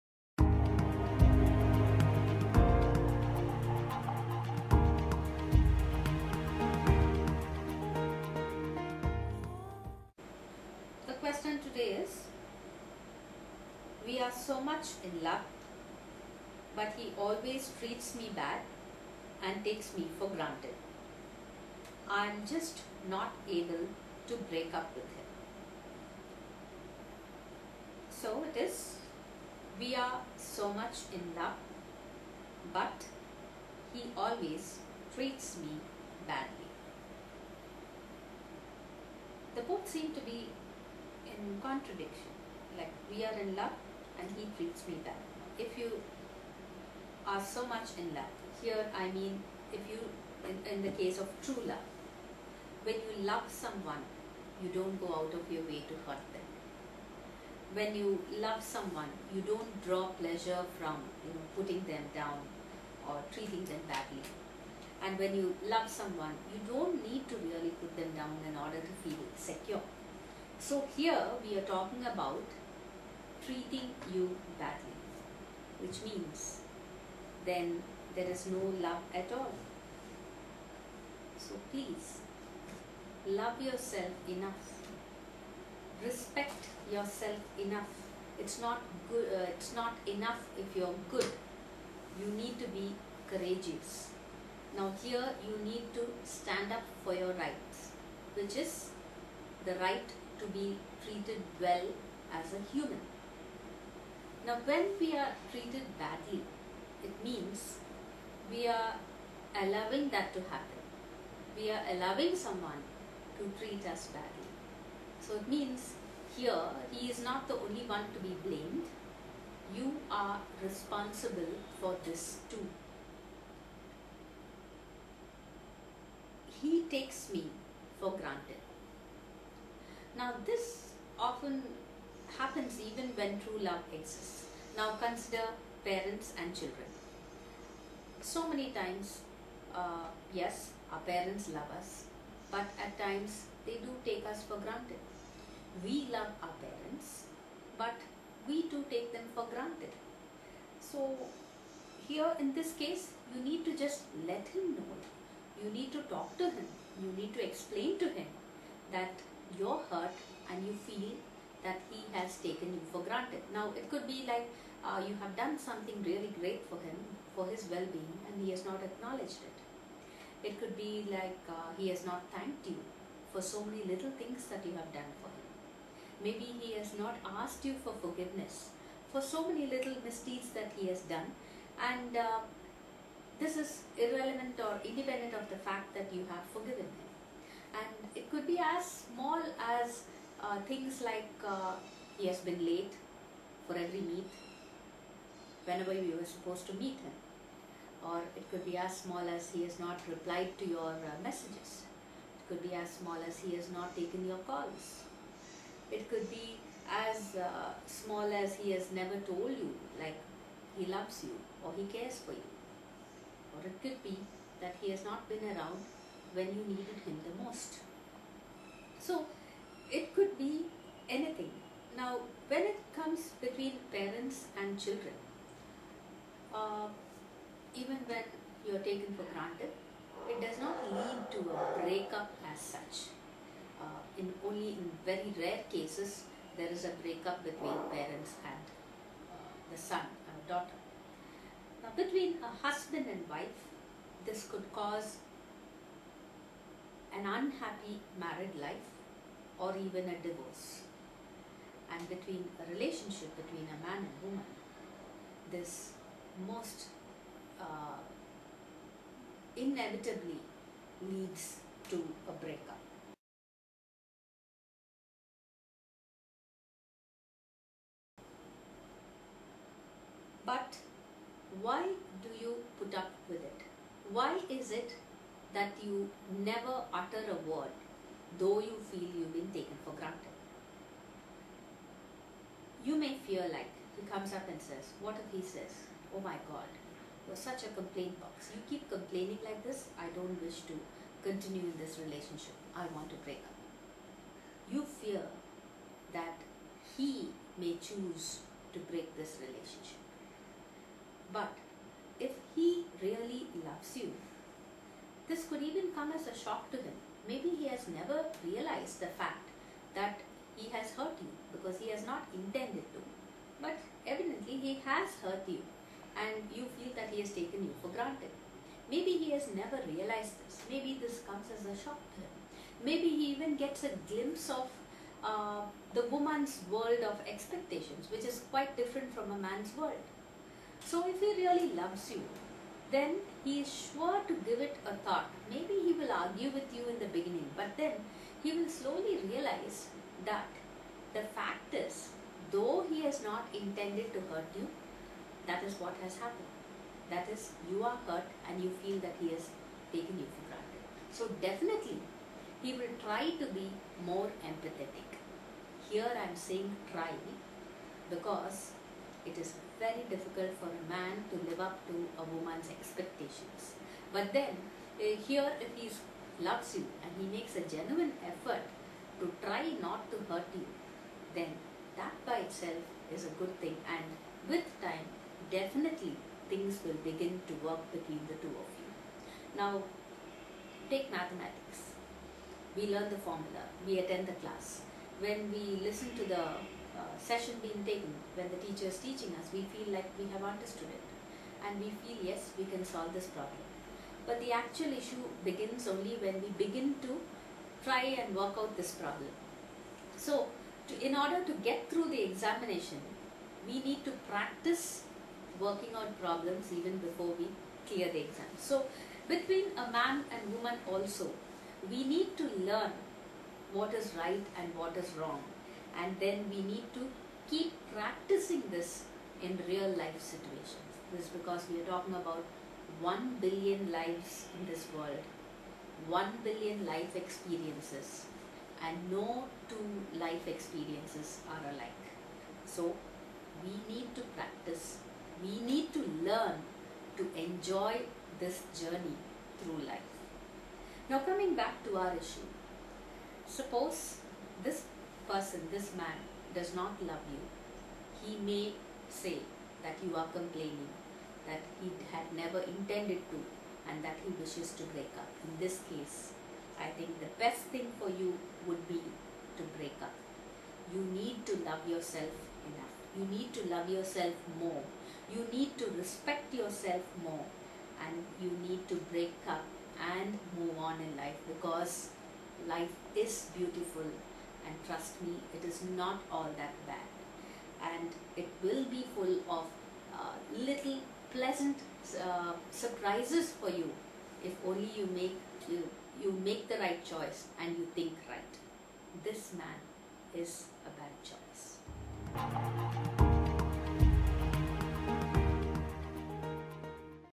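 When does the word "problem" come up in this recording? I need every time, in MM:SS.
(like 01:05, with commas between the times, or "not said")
06:33, 06:38, 06:46.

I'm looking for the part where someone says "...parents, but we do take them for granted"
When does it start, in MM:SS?
02:26.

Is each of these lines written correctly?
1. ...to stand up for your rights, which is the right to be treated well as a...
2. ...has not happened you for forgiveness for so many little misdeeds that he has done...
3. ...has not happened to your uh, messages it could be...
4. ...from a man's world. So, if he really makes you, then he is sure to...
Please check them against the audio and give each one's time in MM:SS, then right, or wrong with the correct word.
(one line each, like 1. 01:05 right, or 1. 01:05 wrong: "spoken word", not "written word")
1. 01:35 right
2. 02:56 wrong: "asked", not "happened"
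3. 03:19 wrong: "replied", not "happened"
4. 05:29 wrong: "loves", not "makes".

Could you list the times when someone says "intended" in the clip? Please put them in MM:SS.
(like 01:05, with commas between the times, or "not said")
05:12, 05:43, 07:32.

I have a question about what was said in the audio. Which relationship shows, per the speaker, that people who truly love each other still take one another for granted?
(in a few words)
parents and children.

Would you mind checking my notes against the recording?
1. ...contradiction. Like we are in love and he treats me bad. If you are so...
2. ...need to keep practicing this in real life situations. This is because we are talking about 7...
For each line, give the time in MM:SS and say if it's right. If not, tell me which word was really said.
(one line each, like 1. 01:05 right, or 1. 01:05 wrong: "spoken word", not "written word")
1. 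00:41 right
2. 06:56 wrong: "1", not "7".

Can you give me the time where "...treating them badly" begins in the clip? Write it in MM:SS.
01:03.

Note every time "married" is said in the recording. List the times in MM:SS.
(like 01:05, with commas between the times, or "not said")
04:08.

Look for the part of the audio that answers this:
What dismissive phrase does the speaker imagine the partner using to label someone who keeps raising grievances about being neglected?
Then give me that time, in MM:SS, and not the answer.
04:47.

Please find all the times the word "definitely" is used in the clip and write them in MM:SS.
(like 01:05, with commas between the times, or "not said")
05:51, 06:15.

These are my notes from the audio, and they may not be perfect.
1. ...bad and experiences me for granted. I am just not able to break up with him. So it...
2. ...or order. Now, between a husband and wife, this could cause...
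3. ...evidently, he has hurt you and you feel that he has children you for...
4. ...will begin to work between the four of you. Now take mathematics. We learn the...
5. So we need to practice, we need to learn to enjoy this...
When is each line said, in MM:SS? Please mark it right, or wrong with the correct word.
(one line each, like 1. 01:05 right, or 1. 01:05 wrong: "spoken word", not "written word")
1. 00:18 wrong: "takes", not "experiences"
2. 04:00 wrong: "daughter", not "order"
3. 05:14 wrong: "taken", not "children"
4. 06:16 wrong: "two", not "four"
5. 07:12 right.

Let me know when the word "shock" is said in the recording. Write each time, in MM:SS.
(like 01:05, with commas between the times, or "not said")
05:06, 05:21.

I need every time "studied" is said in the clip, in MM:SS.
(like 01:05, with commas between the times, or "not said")
not said.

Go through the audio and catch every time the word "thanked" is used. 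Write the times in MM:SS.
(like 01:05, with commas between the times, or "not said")
02:52.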